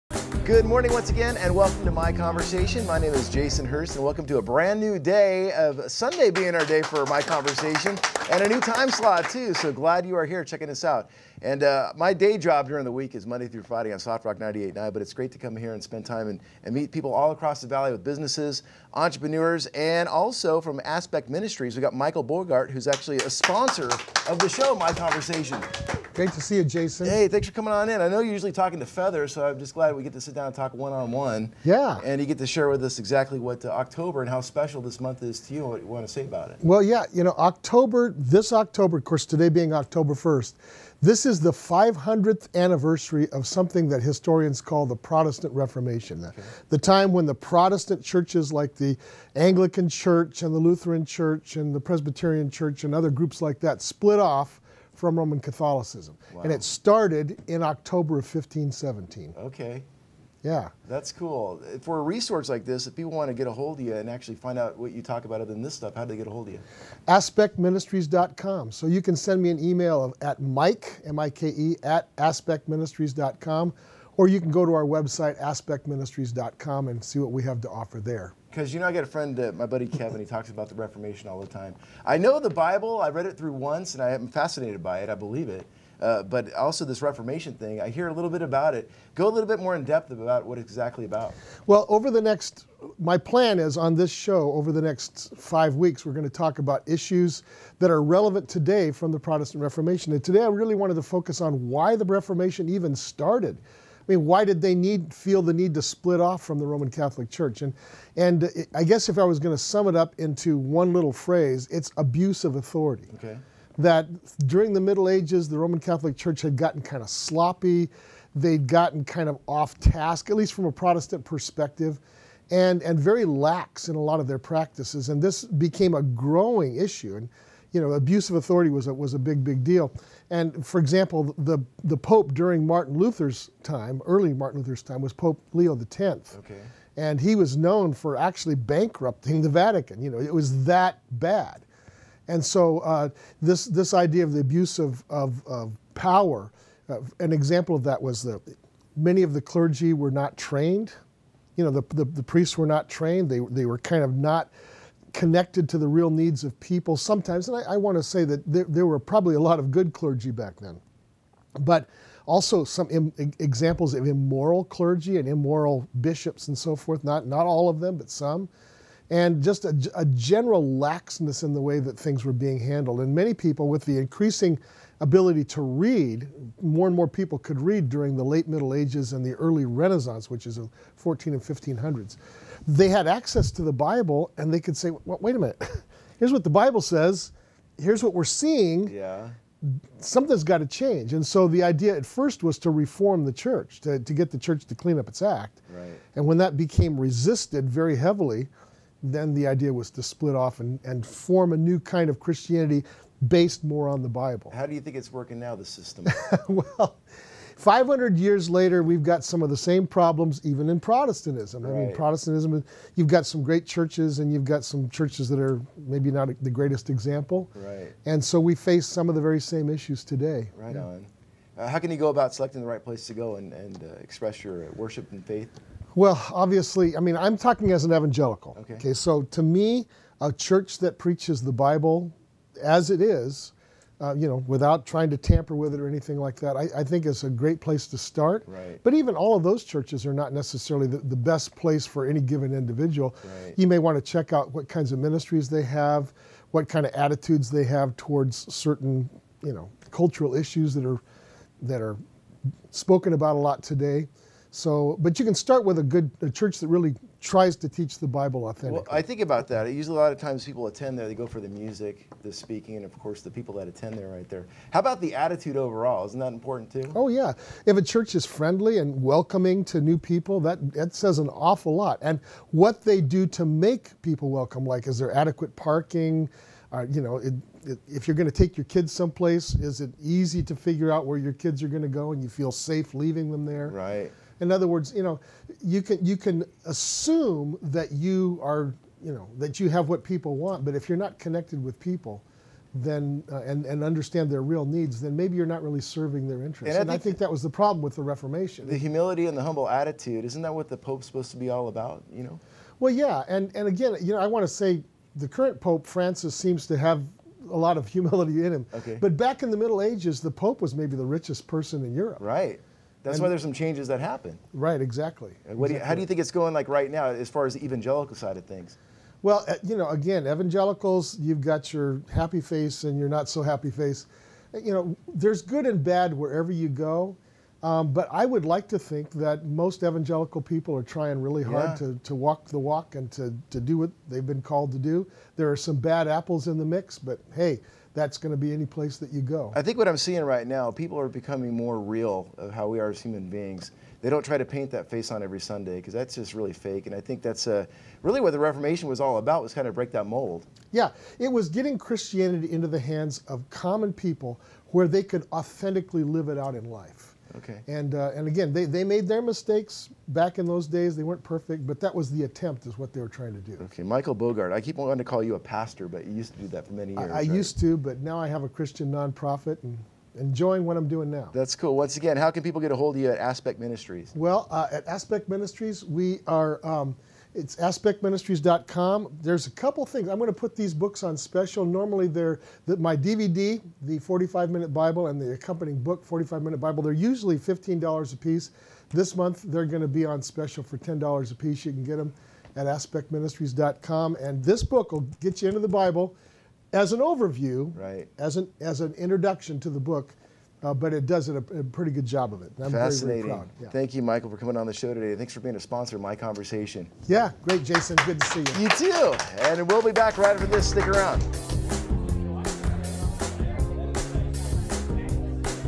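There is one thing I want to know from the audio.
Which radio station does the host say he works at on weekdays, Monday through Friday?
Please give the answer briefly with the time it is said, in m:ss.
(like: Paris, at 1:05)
Soft Rock 98.9, at 0:13.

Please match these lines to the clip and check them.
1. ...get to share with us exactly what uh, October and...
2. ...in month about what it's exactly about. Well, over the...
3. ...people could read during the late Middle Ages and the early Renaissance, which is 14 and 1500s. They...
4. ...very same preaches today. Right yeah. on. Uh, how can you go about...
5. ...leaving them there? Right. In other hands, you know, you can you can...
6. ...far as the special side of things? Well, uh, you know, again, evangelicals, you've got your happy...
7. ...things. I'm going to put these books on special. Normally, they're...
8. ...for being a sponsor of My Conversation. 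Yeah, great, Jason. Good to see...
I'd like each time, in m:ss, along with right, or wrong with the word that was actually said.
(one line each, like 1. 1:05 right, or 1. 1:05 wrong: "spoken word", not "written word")
1. 0:32 right
2. 1:29 wrong: "depth", not "month"
3. 2:57 right
4. 3:39 wrong: "issues", not "preaches"
5. 4:42 wrong: "words", not "hands"
6. 5:17 wrong: "evangelical", not "special"
7. 6:19 right
8. 6:45 right.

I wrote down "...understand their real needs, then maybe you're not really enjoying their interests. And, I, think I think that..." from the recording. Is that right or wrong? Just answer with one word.
wrong.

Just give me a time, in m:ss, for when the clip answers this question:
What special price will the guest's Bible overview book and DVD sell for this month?
6:30.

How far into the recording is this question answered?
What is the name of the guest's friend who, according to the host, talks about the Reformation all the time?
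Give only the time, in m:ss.
1:19.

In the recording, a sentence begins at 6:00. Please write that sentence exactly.
They weren't perfect, but that was the attempt, is what they were trying to do.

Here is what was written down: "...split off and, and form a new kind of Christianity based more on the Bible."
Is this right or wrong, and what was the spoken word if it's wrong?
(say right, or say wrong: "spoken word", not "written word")
right.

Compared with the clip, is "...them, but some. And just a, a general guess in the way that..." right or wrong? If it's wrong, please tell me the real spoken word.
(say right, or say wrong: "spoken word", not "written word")
wrong: "laxness", not "guess".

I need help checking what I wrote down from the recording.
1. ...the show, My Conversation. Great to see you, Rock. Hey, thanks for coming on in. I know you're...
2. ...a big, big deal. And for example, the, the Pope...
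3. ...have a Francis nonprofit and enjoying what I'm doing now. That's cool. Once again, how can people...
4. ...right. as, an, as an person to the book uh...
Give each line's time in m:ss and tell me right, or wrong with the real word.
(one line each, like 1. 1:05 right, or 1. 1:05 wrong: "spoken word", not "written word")
1. 0:24 wrong: "Jason", not "Rock"
2. 2:09 right
3. 6:08 wrong: "Christian", not "Francis"
4. 6:37 wrong: "introduction", not "person".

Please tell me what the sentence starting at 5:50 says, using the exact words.
Yeah, it was getting Christianity into the hands of common people where they could authentically live it out in life.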